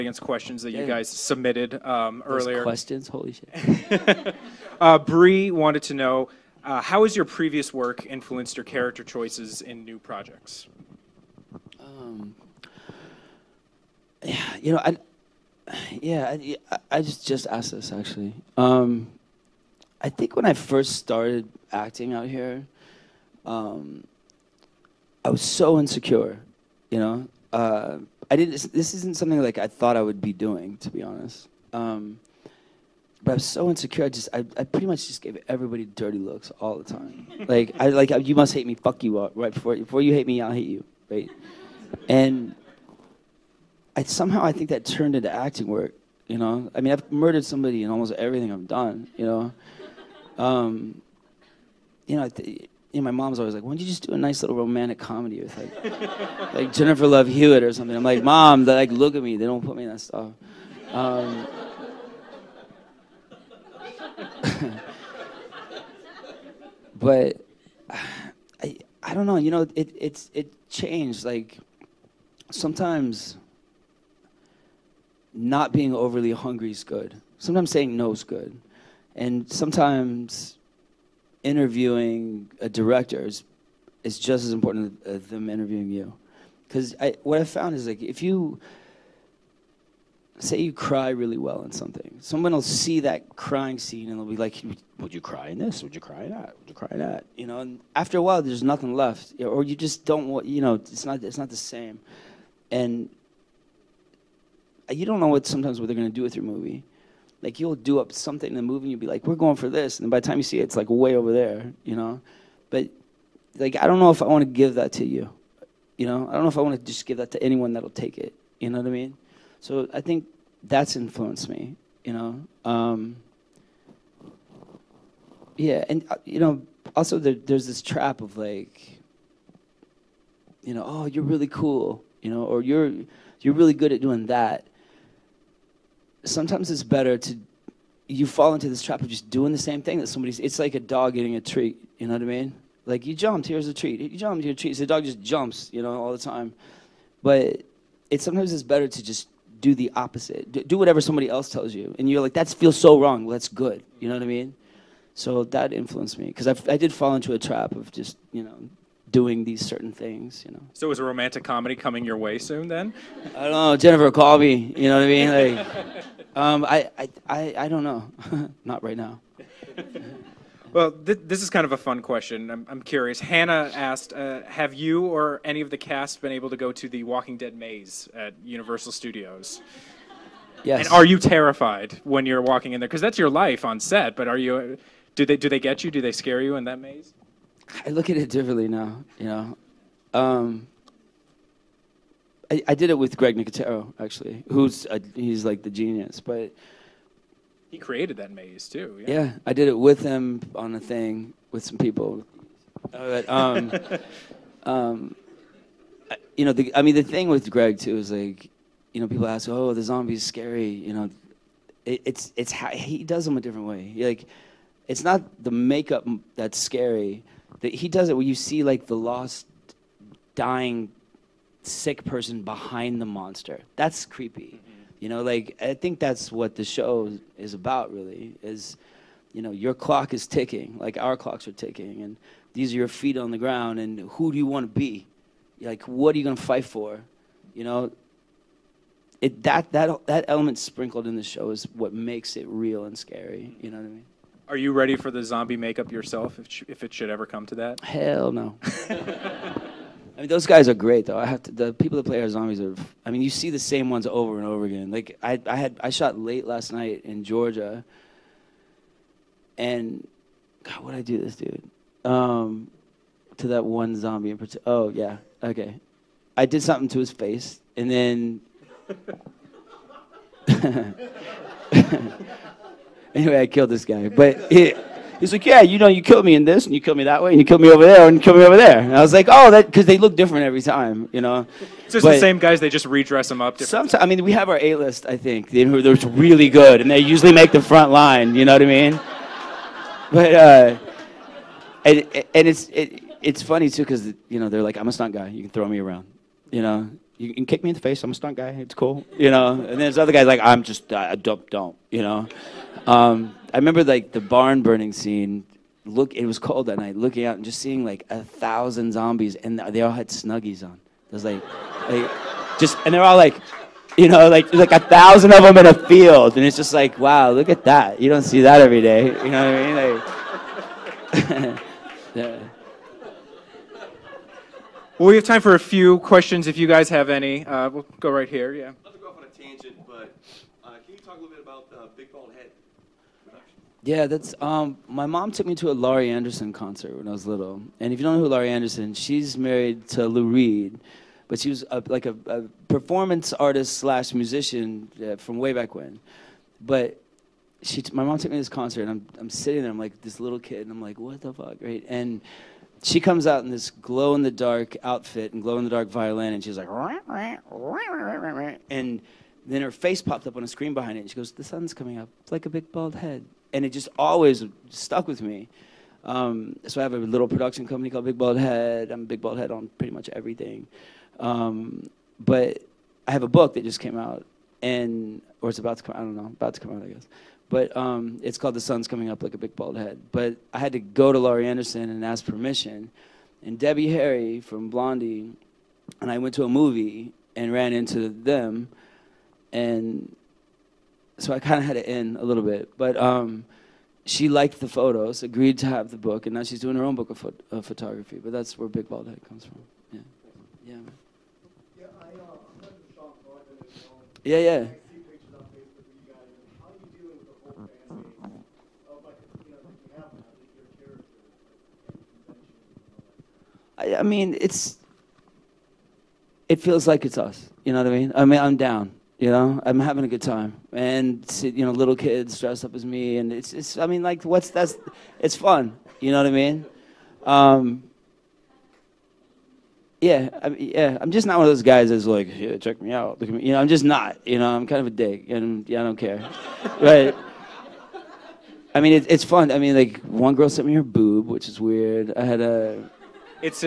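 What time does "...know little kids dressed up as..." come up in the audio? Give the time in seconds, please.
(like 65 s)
421 s.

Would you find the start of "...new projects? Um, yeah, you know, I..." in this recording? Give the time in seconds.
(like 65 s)
9 s.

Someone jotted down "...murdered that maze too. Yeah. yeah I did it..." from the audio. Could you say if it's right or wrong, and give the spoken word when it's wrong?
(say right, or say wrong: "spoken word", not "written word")
wrong: "created", not "murdered".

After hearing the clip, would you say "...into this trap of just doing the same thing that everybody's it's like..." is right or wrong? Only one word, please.
wrong.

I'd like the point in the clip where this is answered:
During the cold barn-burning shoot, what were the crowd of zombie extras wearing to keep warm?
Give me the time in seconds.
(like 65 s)
310 s.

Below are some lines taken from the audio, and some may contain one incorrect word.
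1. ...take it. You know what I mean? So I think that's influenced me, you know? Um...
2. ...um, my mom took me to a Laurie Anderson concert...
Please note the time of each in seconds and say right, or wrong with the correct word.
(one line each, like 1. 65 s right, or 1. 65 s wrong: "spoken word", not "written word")
1. 117 s right
2. 334 s right.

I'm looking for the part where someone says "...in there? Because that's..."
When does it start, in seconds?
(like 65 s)
182 s.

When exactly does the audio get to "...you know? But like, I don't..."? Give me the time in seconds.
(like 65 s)
111 s.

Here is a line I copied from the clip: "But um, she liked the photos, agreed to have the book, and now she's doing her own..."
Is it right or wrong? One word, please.
right.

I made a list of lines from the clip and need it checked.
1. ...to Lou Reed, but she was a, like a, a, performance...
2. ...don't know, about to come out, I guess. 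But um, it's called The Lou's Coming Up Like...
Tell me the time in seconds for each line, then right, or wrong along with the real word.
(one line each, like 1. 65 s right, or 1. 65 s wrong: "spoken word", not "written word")
1. 339 s right
2. 376 s wrong: "Sun", not "Lou".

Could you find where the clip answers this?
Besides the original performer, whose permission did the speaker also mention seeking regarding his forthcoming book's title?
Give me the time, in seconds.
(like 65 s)
383 s.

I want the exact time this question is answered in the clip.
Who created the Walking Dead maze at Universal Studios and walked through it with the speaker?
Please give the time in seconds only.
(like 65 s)
193 s.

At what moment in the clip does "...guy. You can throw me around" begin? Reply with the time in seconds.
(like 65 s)
295 s.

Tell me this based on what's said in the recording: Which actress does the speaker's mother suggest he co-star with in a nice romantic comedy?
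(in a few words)
Jennifer Love Hewitt.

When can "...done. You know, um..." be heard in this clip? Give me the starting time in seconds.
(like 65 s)
48 s.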